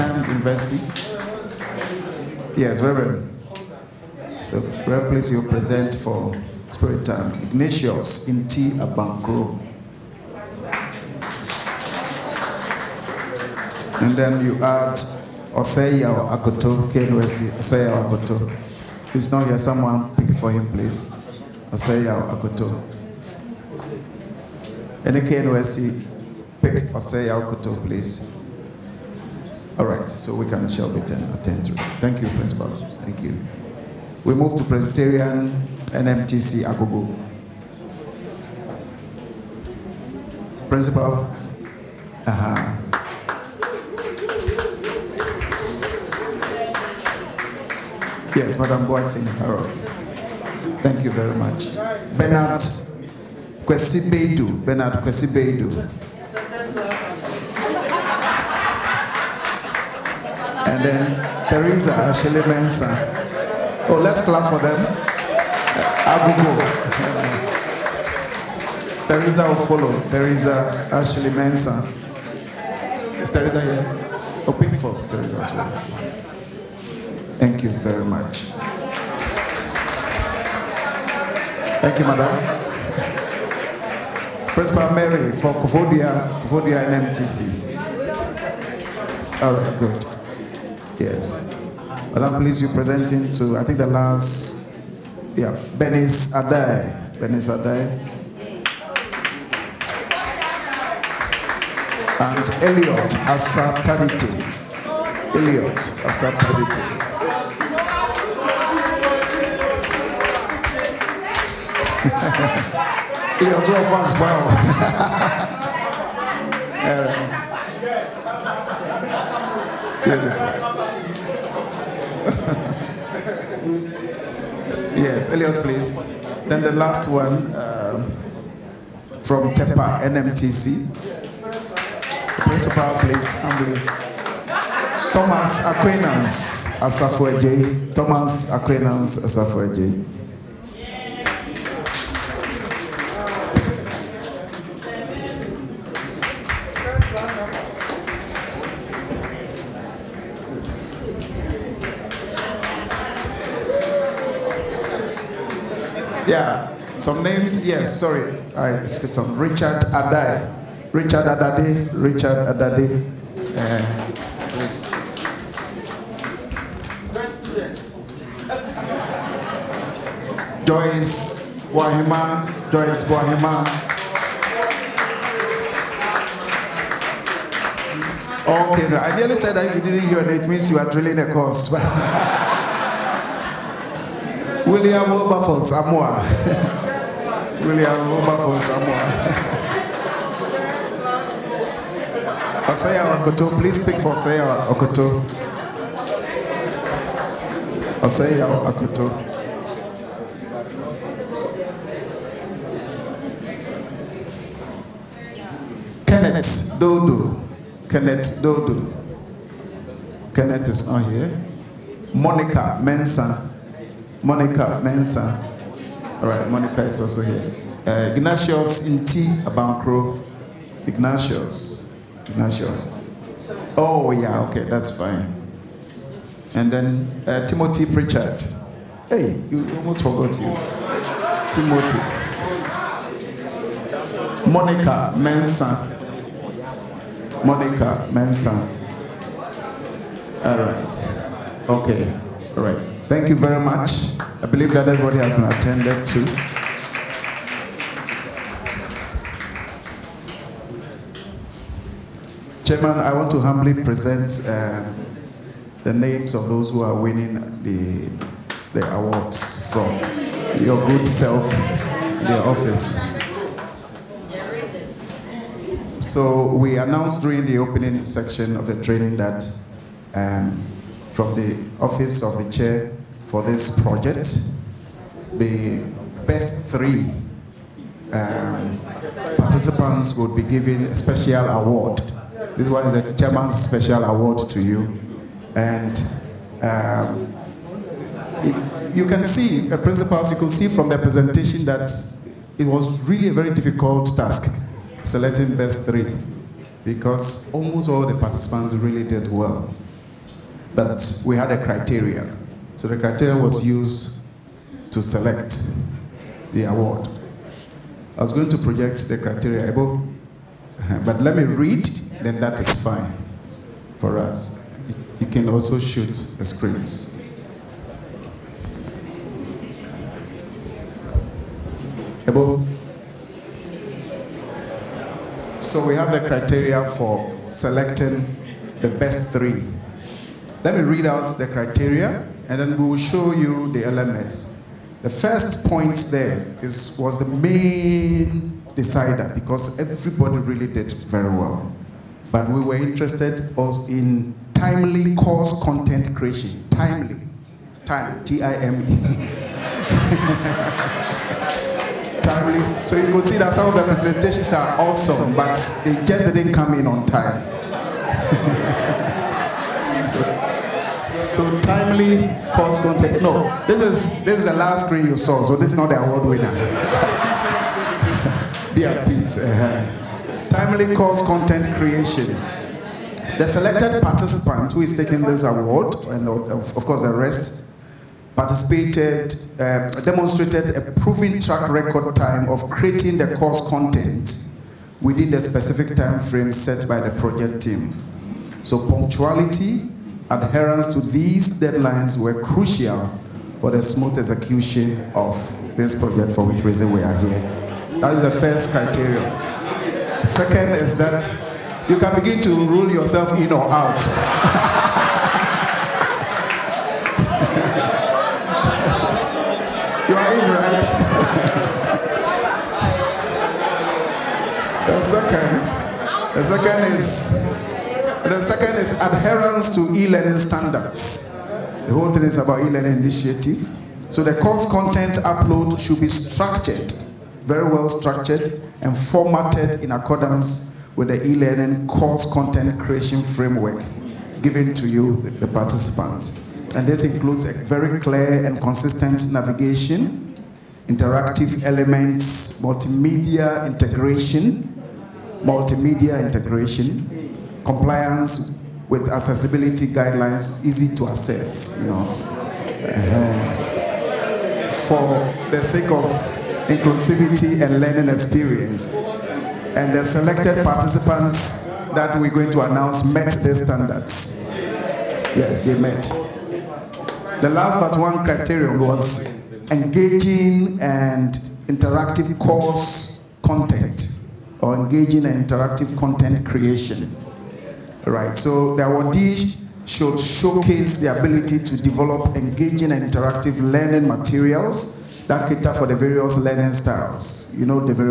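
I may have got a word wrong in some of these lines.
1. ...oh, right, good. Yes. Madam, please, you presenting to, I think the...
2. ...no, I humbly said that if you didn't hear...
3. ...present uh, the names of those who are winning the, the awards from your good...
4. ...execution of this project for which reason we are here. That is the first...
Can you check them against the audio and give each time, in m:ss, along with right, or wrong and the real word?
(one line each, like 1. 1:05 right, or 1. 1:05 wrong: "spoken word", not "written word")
1. 1:29 right
2. 2:58 wrong: "nearly", not "humbly"
3. 4:13 right
4. 6:34 right.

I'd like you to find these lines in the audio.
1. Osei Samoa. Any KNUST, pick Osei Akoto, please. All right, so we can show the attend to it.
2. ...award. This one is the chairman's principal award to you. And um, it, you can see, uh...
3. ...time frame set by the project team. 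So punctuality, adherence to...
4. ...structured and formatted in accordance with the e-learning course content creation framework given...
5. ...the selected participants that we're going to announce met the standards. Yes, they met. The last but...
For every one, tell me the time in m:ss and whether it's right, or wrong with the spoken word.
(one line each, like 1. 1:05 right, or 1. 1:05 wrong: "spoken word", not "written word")
1. 0:21 wrong: "Akoto", not "Samoa"
2. 4:41 wrong: "special", not "principal"
3. 6:25 right
4. 7:07 right
5. 7:39 right.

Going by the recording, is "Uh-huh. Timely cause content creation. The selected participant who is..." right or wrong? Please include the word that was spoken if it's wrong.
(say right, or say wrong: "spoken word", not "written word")
right.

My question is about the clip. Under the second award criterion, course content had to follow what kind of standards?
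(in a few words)
e-learning standards.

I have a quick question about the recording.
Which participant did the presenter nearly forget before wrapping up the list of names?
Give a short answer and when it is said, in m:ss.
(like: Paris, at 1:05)
Timothy Pritchard, at 3:47.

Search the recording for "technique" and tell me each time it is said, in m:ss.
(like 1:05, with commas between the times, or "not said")
not said.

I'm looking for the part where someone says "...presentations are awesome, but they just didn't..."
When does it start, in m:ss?
5:53.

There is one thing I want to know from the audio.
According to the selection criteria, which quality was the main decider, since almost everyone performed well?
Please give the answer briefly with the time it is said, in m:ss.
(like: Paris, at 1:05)
timely course content creation, at 5:44.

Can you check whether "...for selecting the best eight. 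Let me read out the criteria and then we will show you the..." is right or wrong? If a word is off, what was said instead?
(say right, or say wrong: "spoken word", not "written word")
wrong: "three", not "eight".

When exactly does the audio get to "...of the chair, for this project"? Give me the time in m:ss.
4:32.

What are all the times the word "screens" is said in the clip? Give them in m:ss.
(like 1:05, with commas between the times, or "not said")
5:16, 6:04.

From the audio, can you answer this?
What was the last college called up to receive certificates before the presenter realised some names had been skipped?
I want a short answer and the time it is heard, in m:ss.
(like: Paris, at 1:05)
TEPA NMTC, at 2:09.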